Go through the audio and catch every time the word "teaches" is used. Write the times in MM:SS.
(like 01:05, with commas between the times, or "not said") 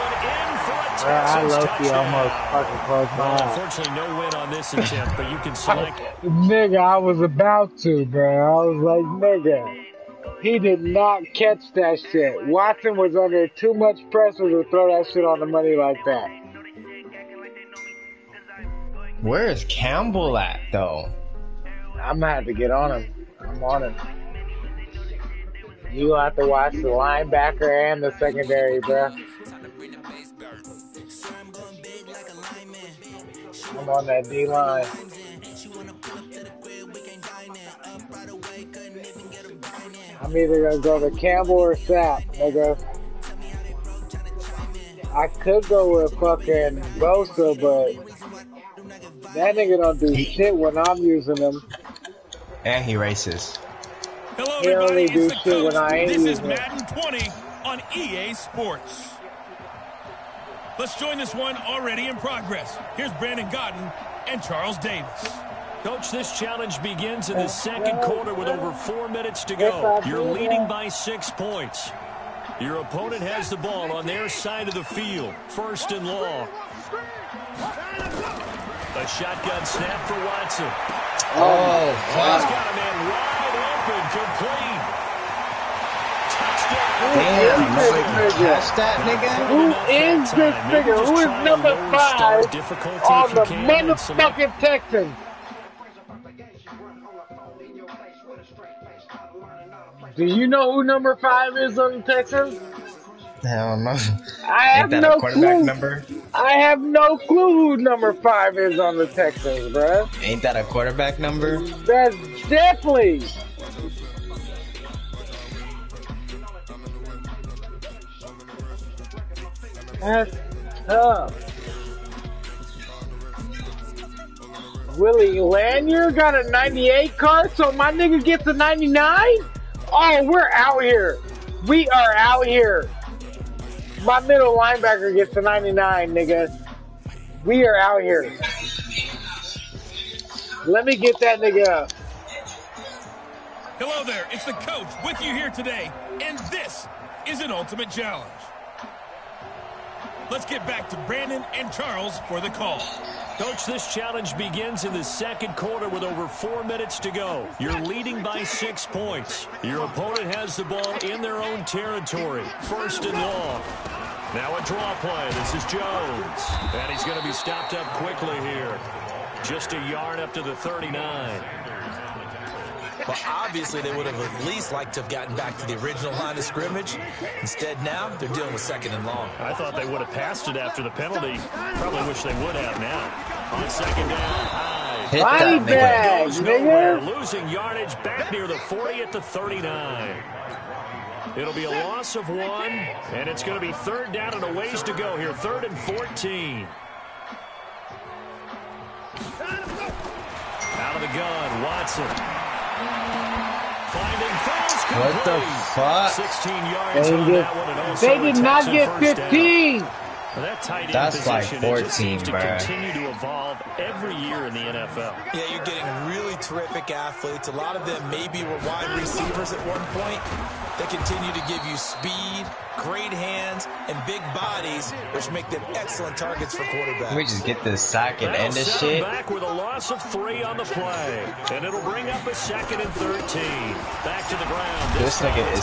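not said.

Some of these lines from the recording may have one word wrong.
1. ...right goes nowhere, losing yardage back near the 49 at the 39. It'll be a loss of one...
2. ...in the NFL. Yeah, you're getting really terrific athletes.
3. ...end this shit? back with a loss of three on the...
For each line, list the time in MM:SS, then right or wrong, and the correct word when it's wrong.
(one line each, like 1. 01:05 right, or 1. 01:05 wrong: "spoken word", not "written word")
1. 03:05 wrong: "40", not "49"
2. 03:34 right
3. 03:48 right.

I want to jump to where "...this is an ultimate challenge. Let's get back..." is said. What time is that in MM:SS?
02:26.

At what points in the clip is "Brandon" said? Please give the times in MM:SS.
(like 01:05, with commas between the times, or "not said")
01:03, 02:31.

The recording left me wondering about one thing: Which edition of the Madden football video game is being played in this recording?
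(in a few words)
Madden 20.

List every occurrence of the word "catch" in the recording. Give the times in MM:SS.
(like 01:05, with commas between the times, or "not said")
00:11, 01:28.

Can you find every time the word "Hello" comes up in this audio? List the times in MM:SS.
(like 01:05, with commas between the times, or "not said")
00:54, 02:23.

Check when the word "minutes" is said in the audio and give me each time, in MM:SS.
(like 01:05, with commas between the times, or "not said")
01:09, 02:36.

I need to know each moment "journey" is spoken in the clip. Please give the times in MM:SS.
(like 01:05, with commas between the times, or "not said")
not said.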